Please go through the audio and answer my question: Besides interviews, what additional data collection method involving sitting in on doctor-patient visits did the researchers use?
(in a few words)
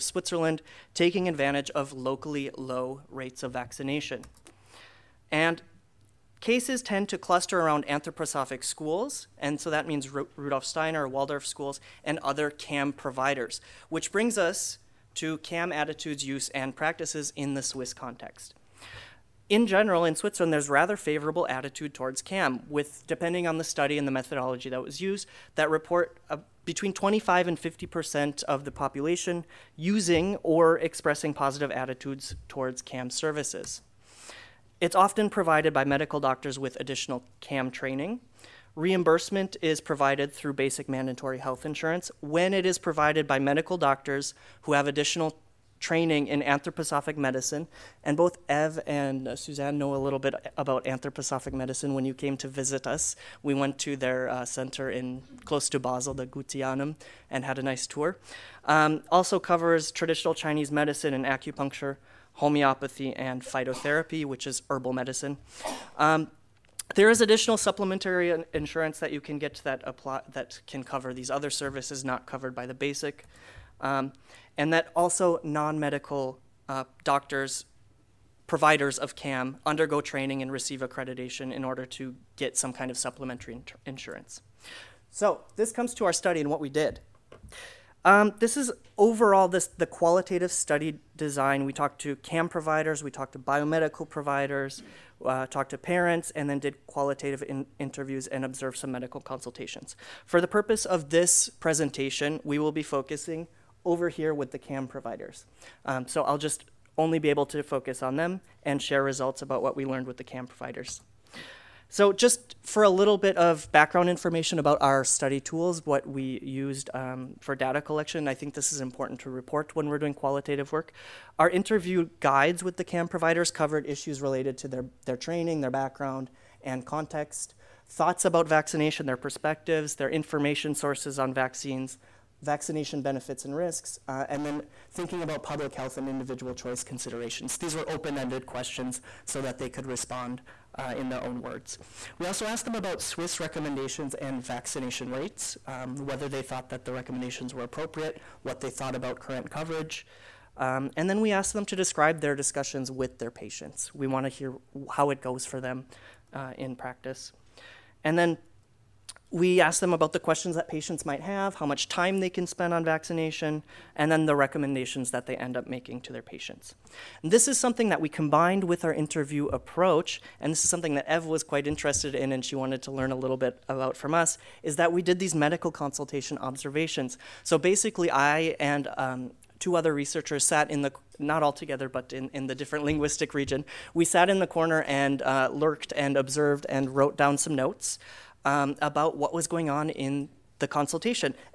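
medical consultation observations.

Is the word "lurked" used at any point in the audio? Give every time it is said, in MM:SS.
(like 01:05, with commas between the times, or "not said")
03:05.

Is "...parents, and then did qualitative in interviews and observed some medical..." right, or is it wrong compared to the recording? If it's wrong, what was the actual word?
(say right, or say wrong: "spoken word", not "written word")
right.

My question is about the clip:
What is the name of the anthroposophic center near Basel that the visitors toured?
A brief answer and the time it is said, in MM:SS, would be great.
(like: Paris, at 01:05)
the Goetheanum, at 00:56.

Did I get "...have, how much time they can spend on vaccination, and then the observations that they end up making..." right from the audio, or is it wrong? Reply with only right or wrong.
wrong.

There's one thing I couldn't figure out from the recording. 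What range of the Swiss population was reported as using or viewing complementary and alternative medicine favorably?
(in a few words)
25 to 50 percent.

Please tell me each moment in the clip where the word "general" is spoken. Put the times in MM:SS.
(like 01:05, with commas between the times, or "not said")
00:19.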